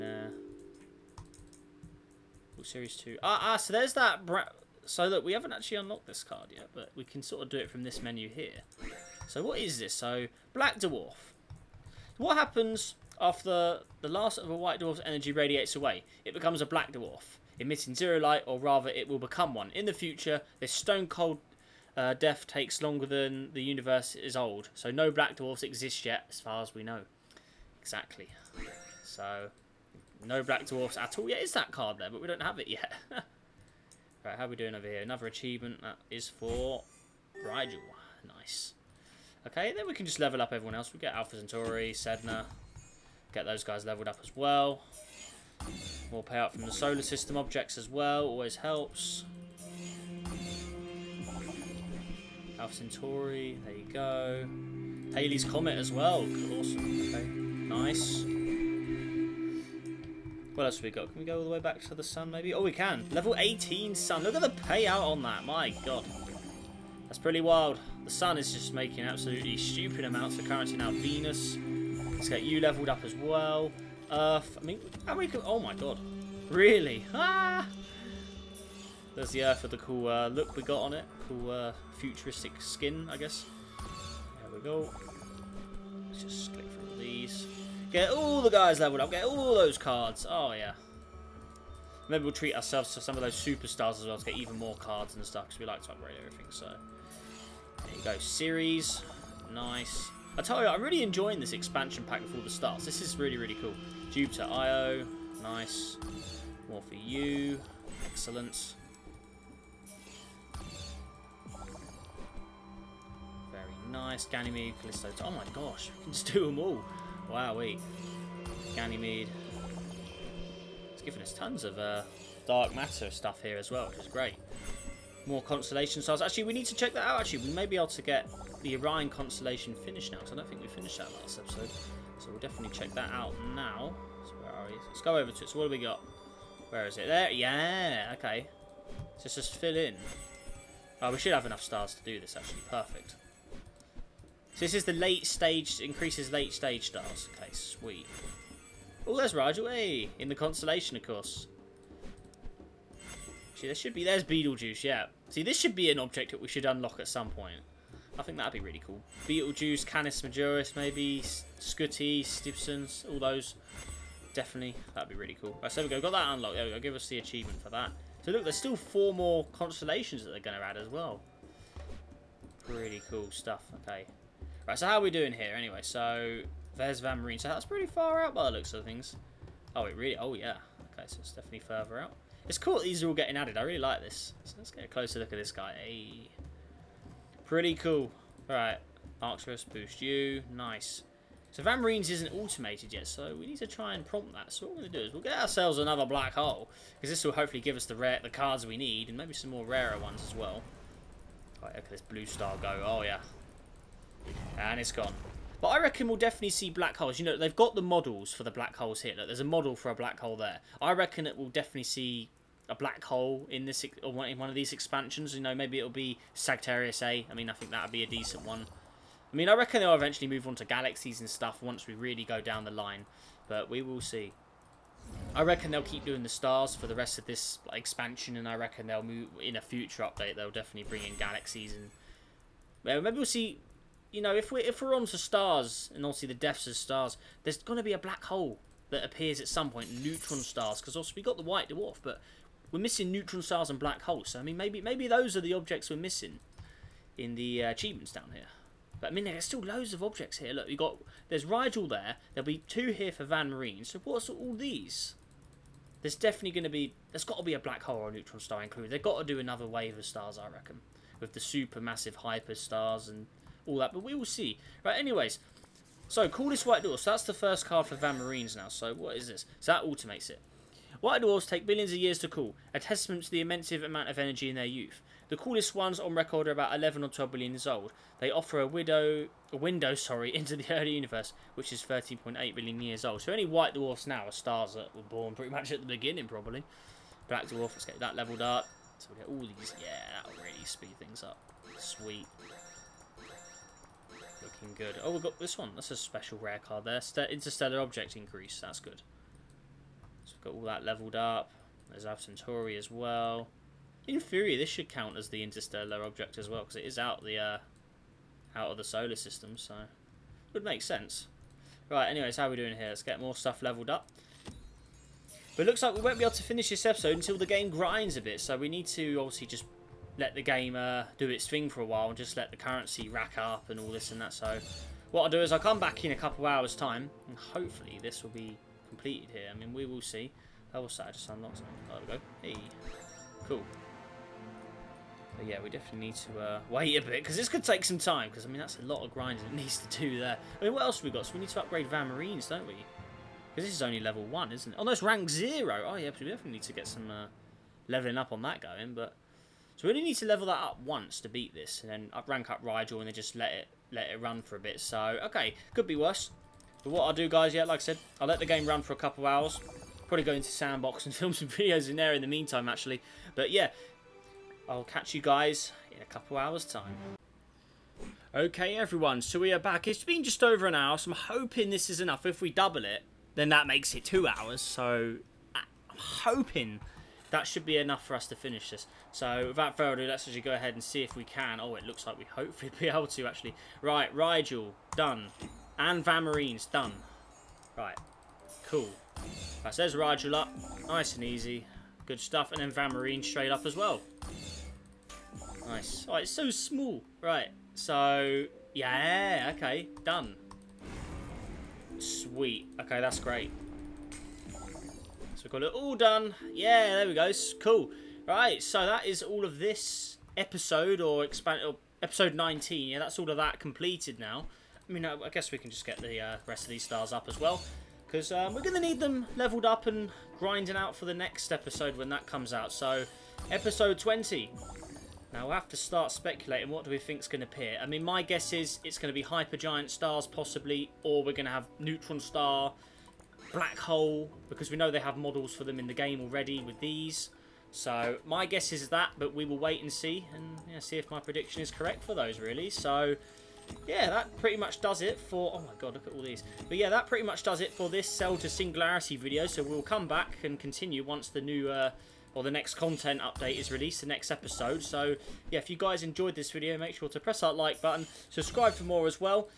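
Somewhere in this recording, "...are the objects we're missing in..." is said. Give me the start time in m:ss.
4:05.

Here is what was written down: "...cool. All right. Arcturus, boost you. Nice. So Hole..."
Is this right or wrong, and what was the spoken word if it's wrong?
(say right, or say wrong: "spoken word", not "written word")
wrong: "Van", not "Hole".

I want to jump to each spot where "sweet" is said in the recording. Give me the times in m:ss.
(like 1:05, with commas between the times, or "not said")
2:27, 4:51, 6:41.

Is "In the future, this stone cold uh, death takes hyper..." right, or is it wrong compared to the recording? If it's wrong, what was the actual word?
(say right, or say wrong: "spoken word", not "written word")
wrong: "longer", not "hyper".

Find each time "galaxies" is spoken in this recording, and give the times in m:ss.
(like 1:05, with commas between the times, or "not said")
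3:40, 3:51.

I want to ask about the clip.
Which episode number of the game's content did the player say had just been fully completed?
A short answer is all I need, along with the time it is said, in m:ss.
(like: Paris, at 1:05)
19, at 6:52.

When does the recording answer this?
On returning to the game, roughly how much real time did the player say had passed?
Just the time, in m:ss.
6:10.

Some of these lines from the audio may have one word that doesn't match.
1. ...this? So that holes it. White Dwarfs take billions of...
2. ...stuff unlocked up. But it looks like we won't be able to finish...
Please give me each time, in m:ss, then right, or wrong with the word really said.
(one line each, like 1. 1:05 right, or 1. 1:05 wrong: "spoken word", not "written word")
1. 4:29 wrong: "automates", not "holes"
2. 5:13 wrong: "leveled", not "unlocked".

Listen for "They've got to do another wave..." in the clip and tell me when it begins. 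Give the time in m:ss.
4:18.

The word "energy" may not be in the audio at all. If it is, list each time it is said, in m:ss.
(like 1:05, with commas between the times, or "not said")
0:15, 4:34.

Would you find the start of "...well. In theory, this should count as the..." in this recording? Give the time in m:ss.
5:02.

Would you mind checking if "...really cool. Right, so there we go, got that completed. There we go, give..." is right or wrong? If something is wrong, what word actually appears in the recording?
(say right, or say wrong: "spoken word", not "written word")
wrong: "unlocked", not "completed".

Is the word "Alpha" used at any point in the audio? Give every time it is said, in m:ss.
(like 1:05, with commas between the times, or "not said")
0:41, 0:52, 5:02.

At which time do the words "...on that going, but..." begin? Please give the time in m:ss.
5:48.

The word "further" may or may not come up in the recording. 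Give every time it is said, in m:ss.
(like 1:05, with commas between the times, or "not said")
3:01, 6:19.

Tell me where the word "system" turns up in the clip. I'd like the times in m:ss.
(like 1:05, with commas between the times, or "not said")
0:47, 5:09.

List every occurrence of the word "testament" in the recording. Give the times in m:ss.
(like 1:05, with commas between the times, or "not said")
4:32.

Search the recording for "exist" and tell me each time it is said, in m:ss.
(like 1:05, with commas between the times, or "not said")
0:25.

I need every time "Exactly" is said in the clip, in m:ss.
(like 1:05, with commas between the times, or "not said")
0:27.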